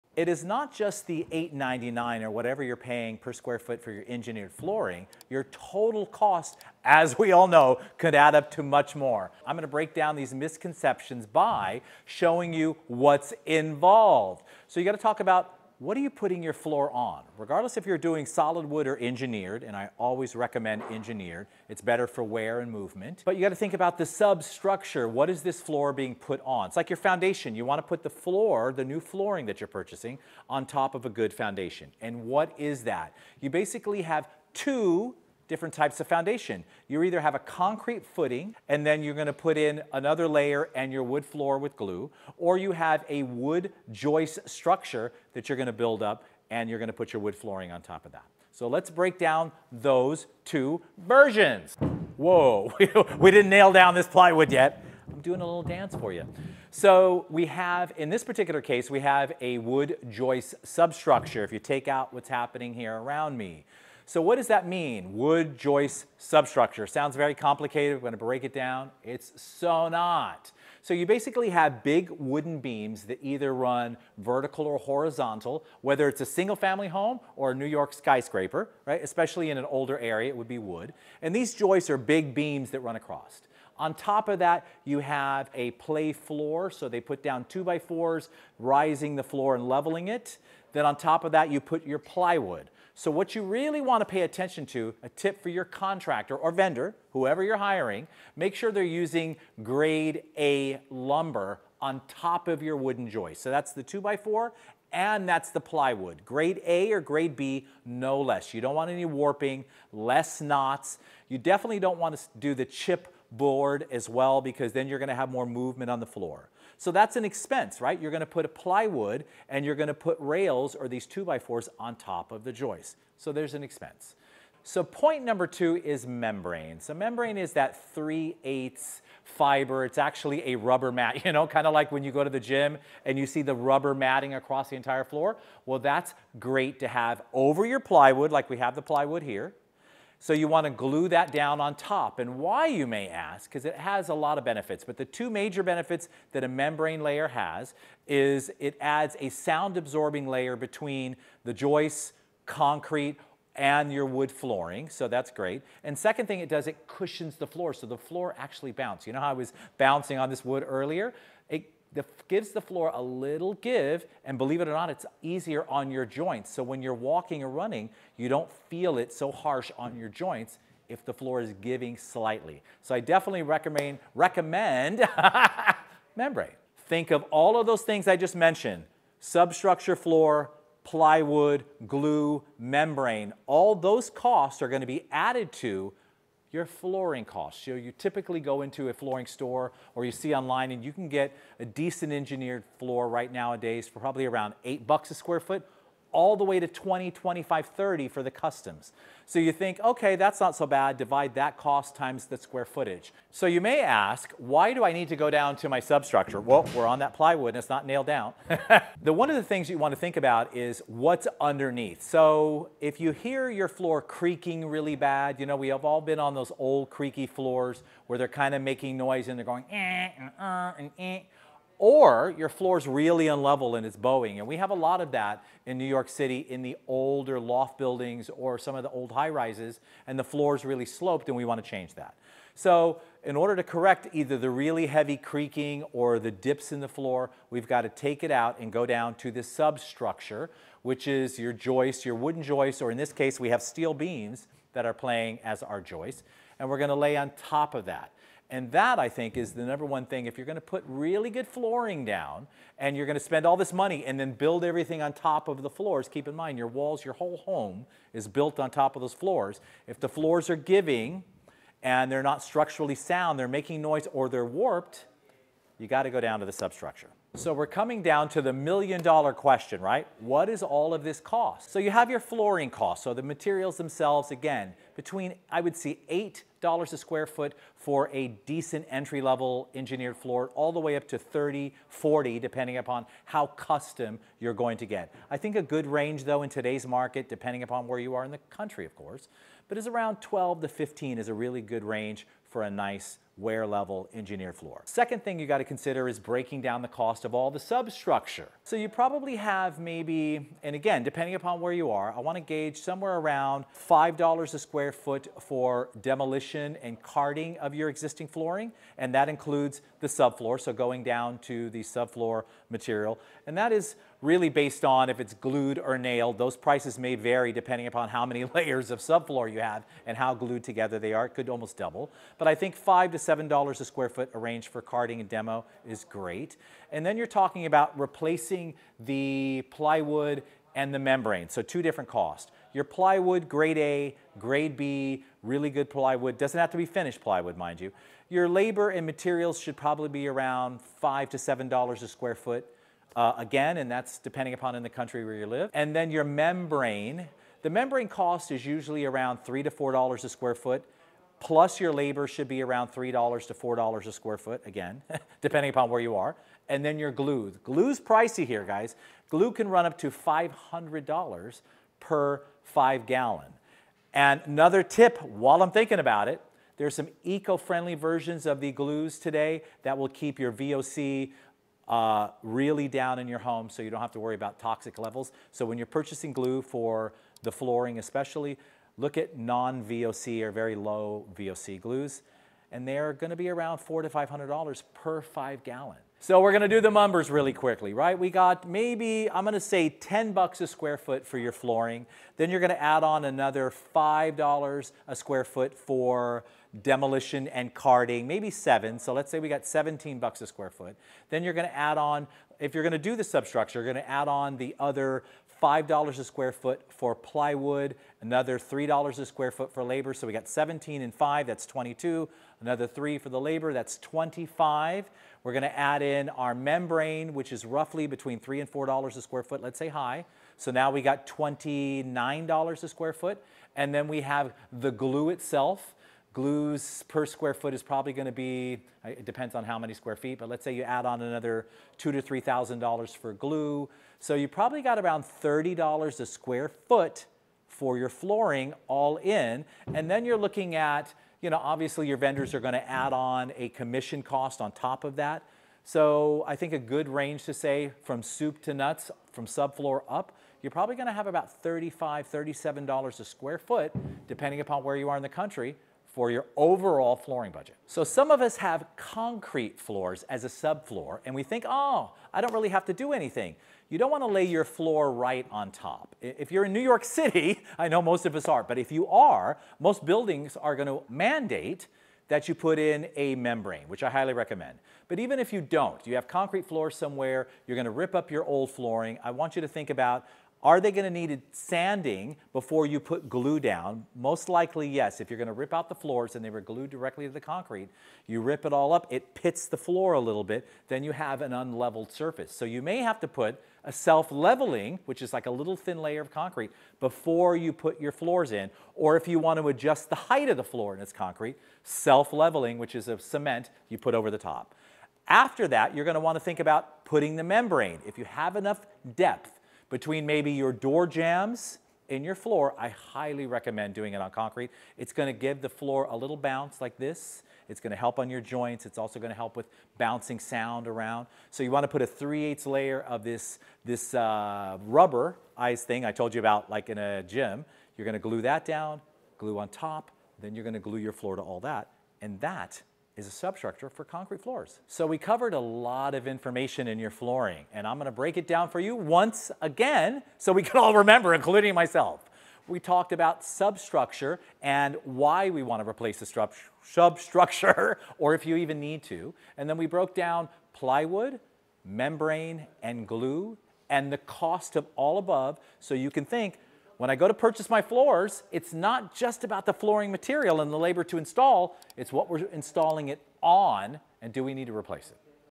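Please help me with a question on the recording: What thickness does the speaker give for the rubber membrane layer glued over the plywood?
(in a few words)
3/8.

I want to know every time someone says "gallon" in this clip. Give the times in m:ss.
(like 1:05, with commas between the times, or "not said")
6:03, 6:25.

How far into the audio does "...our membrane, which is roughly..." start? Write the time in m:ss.
6:56.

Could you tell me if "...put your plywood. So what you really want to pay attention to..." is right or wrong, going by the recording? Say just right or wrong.
right.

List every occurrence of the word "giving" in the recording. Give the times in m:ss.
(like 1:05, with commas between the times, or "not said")
2:51, 4:20.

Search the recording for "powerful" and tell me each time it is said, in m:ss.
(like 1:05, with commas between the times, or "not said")
not said.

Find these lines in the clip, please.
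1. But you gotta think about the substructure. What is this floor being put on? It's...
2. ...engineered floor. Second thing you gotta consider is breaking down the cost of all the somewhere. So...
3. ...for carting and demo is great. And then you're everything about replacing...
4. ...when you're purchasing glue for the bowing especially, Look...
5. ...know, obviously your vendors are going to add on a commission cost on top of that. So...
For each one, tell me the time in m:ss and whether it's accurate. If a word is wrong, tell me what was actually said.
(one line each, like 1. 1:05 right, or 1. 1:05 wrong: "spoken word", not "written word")
1. 0:23 right
2. 4:54 wrong: "substructure", not "somewhere"
3. 5:24 wrong: "talking", not "everything"
4. 6:15 wrong: "flooring", not "bowing"
5. 7:21 right.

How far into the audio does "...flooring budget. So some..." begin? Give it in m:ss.
7:37.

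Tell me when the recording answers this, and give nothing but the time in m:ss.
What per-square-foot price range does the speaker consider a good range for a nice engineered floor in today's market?
4:50.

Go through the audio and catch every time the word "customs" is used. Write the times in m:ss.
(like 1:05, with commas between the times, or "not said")
3:18, 4:43.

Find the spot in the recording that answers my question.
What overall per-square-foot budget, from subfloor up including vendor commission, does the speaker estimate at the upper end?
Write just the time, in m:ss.
7:31.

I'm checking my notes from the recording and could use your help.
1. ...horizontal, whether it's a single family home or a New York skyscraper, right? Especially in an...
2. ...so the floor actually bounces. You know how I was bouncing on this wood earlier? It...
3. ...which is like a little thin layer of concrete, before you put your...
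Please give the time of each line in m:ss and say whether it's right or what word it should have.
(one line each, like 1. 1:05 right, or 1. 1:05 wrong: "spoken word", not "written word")
1. 1:14 right
2. 2:37 right
3. 8:15 right.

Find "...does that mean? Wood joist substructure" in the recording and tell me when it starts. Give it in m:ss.
1:04.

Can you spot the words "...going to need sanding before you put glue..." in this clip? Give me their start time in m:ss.
8:00.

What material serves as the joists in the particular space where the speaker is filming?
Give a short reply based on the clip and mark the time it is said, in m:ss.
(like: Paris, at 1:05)
Steel beams, at 4:03.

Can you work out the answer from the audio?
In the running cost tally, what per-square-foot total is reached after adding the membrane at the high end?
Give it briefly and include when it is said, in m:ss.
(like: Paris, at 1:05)
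$29, at 7:01.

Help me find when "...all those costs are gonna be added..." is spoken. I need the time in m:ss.
3:03.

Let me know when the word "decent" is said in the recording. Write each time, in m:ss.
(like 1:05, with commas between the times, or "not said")
3:11, 4:38.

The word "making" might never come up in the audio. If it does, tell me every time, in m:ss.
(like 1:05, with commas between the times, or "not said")
3:38, 4:23.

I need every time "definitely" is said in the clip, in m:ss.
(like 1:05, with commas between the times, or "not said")
1:51, 2:52.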